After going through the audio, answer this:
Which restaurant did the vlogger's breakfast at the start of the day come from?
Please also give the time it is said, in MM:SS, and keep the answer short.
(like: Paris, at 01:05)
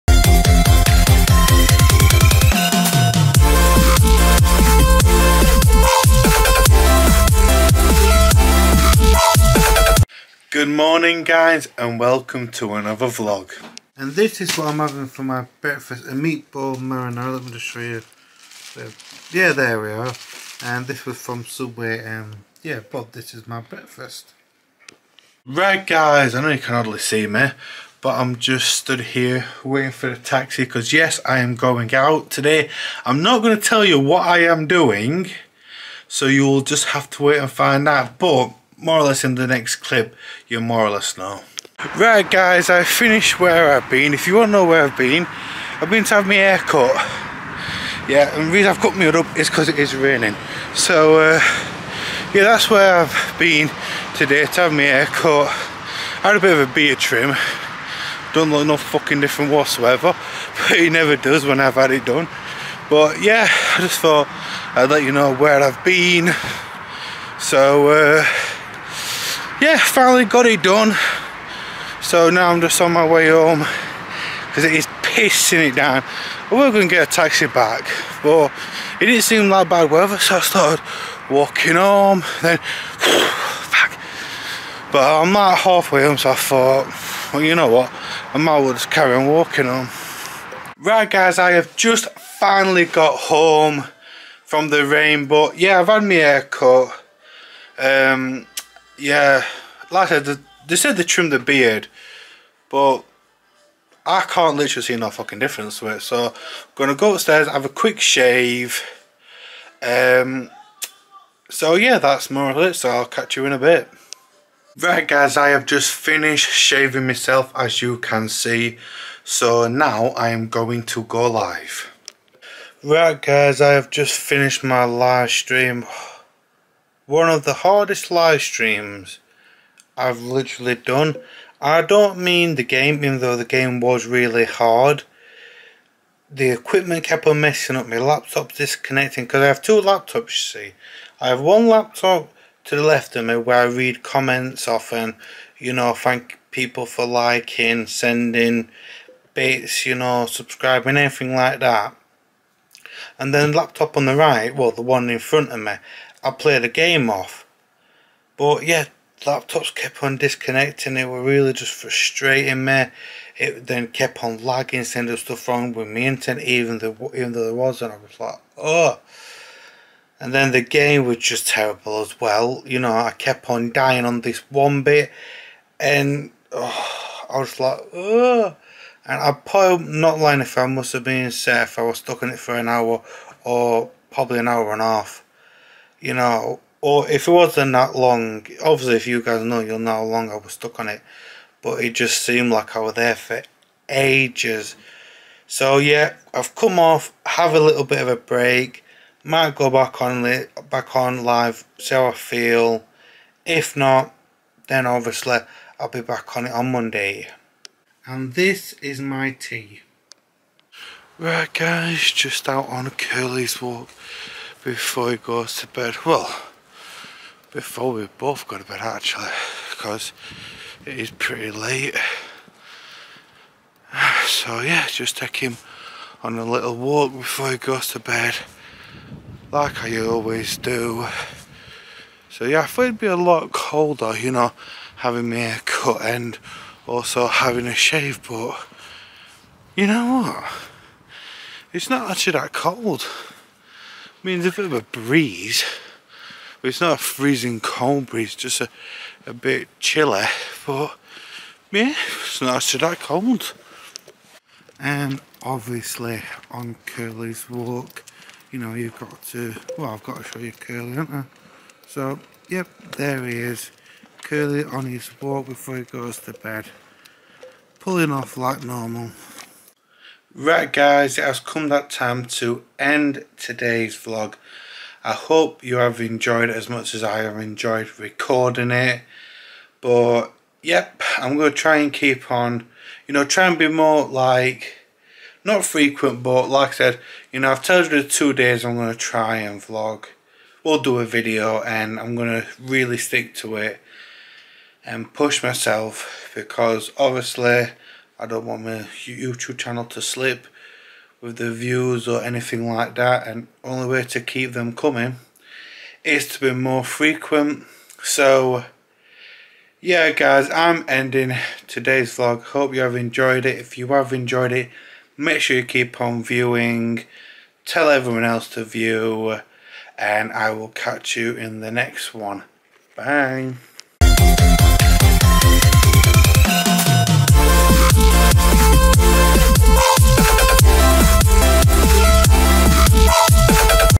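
Subway, at 00:21.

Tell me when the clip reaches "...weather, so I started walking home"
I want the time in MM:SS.
01:19.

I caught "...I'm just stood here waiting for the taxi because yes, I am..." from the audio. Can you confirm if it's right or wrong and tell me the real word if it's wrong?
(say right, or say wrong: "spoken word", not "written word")
right.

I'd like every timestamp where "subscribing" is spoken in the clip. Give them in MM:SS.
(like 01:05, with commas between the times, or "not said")
02:30.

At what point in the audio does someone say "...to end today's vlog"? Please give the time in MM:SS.
04:32.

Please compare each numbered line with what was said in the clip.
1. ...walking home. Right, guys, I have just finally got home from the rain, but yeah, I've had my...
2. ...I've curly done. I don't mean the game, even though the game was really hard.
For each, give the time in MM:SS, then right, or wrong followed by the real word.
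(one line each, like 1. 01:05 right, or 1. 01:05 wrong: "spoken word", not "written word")
1. 01:29 right
2. 02:09 wrong: "literally", not "curly".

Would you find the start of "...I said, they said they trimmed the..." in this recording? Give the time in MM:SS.
01:40.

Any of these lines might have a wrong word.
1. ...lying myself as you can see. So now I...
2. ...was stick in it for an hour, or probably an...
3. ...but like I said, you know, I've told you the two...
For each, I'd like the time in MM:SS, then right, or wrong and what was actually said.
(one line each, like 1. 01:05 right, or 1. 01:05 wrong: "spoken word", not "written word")
1. 01:56 wrong: "shaving", not "lying"
2. 03:01 wrong: "stuck", not "stick"
3. 04:46 right.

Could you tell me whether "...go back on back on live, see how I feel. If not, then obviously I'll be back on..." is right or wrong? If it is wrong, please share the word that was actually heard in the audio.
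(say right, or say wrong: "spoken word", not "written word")
right.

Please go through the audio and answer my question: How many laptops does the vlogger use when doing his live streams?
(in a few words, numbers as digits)
2.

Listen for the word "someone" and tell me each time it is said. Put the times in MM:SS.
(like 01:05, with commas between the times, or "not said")
not said.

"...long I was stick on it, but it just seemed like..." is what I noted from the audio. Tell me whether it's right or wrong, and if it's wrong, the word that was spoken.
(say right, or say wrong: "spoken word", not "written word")
wrong: "stuck", not "stick".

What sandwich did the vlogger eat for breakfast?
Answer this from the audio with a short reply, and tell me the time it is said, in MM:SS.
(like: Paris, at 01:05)
Meatball marinara, at 00:16.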